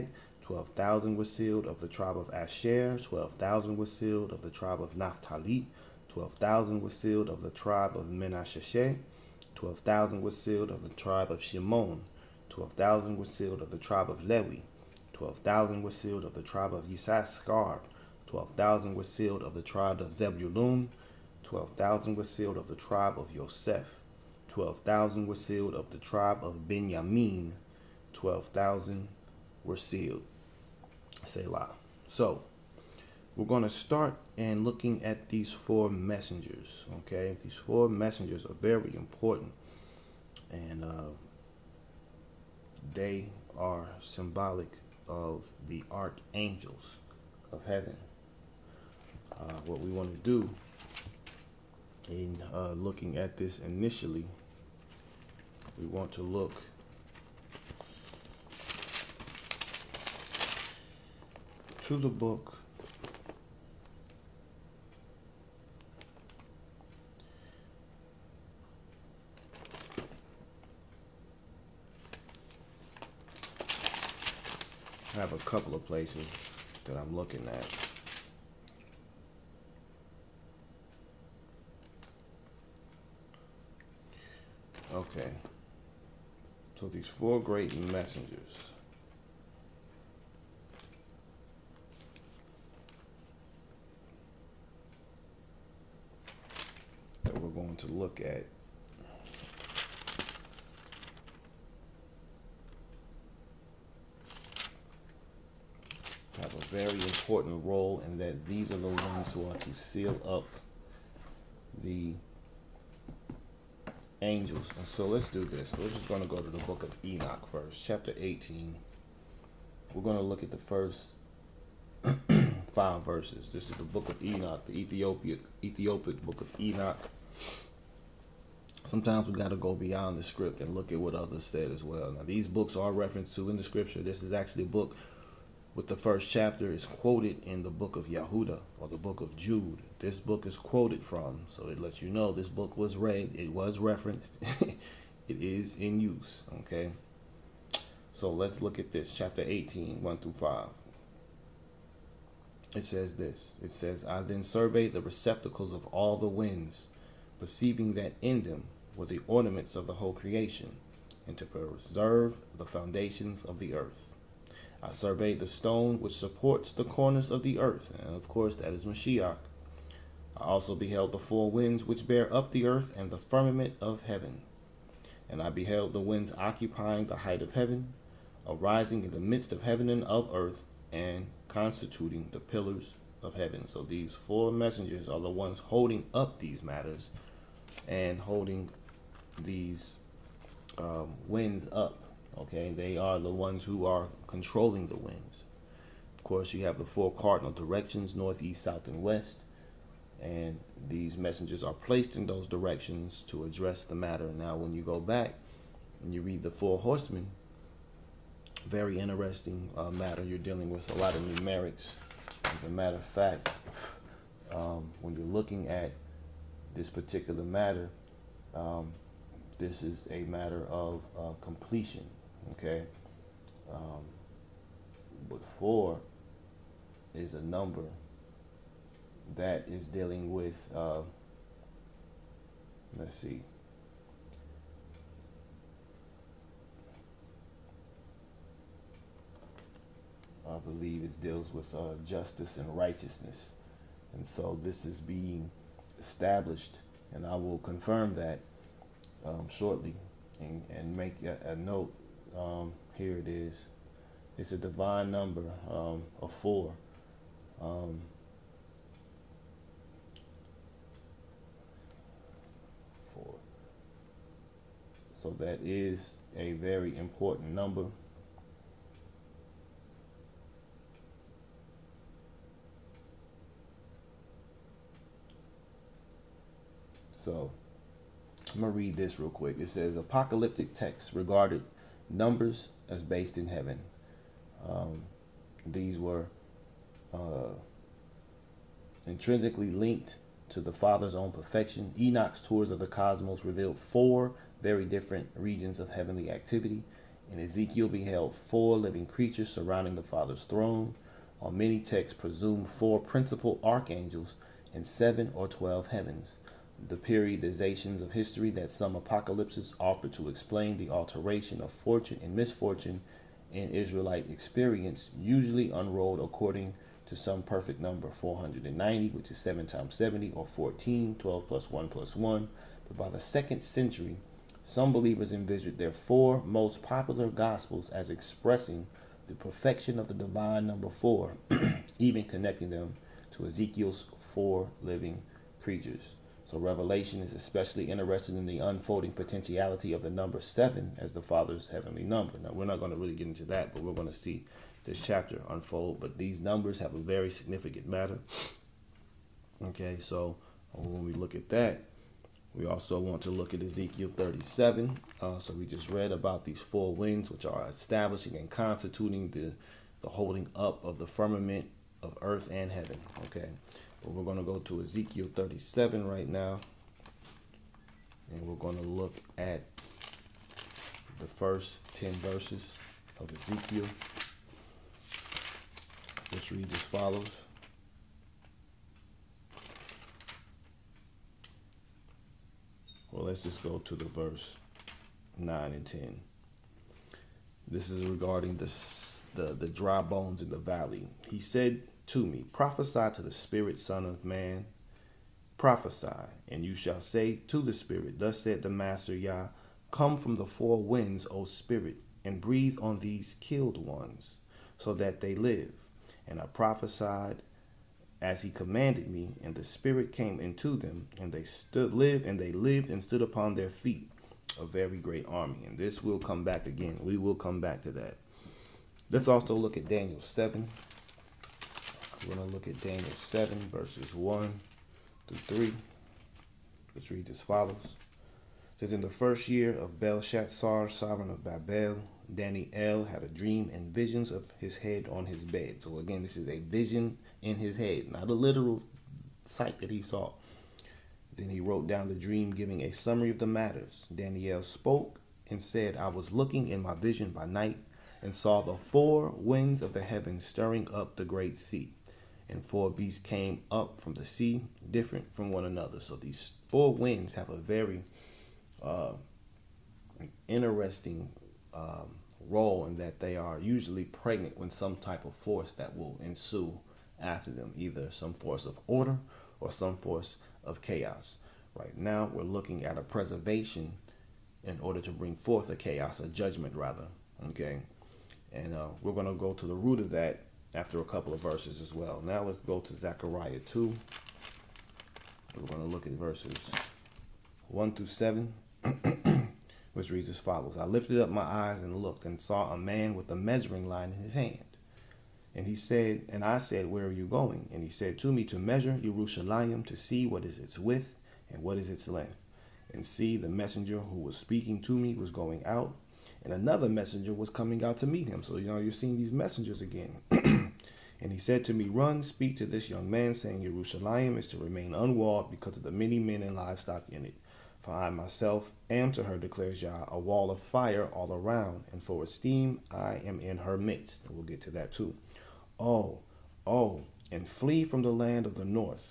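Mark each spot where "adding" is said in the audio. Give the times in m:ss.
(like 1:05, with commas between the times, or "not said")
not said.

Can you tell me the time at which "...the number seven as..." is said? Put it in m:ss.
5:40.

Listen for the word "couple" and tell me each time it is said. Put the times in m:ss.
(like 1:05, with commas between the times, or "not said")
1:15, 8:01.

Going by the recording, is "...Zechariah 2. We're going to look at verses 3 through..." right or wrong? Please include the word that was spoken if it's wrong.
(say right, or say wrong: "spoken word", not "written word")
wrong: "1", not "3".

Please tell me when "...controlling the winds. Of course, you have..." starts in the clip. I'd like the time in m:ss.
3:14.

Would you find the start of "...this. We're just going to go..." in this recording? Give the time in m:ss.
1:55.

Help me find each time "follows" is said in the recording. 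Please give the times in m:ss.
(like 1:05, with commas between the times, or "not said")
6:16, 7:07, 8:10.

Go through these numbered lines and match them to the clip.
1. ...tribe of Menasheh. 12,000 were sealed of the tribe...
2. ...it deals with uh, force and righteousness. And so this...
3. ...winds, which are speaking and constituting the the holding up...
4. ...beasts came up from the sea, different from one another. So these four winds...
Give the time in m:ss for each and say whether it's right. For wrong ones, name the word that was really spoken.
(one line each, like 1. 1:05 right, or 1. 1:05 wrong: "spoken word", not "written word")
1. 0:07 right
2. 4:01 wrong: "justice", not "force"
3. 5:56 wrong: "establishing", not "speaking"
4. 7:32 right.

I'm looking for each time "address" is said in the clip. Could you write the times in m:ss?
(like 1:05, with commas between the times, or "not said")
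3:23.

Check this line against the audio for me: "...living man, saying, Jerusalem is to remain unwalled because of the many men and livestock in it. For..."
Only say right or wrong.
wrong.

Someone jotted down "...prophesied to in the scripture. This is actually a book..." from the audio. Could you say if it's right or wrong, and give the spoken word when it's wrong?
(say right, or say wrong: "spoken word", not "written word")
wrong: "referenced", not "prophesied".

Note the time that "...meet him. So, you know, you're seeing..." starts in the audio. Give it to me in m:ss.
8:28.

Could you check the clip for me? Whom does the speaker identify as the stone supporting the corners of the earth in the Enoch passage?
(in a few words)
Mashiach.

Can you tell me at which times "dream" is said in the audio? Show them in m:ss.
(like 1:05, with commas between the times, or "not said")
7:13, 7:22.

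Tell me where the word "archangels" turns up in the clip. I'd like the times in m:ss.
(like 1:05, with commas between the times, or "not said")
0:45, 5:03.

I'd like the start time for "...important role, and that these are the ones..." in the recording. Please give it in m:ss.
1:47.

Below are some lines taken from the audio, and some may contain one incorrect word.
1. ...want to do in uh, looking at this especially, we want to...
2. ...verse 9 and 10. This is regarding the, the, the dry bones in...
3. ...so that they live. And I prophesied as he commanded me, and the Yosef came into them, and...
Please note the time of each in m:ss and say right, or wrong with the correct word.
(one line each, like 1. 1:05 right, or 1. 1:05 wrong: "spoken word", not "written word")
1. 0:49 wrong: "initially", not "especially"
2. 6:24 right
3. 6:44 wrong: "Spirit", not "Yosef".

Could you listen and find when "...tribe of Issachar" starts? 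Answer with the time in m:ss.
0:16.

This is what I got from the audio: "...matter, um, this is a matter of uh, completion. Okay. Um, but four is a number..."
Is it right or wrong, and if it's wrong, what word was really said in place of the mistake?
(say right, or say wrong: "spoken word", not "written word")
right.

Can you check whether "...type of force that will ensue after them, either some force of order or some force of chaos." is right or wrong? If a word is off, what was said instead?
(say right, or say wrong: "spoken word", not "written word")
right.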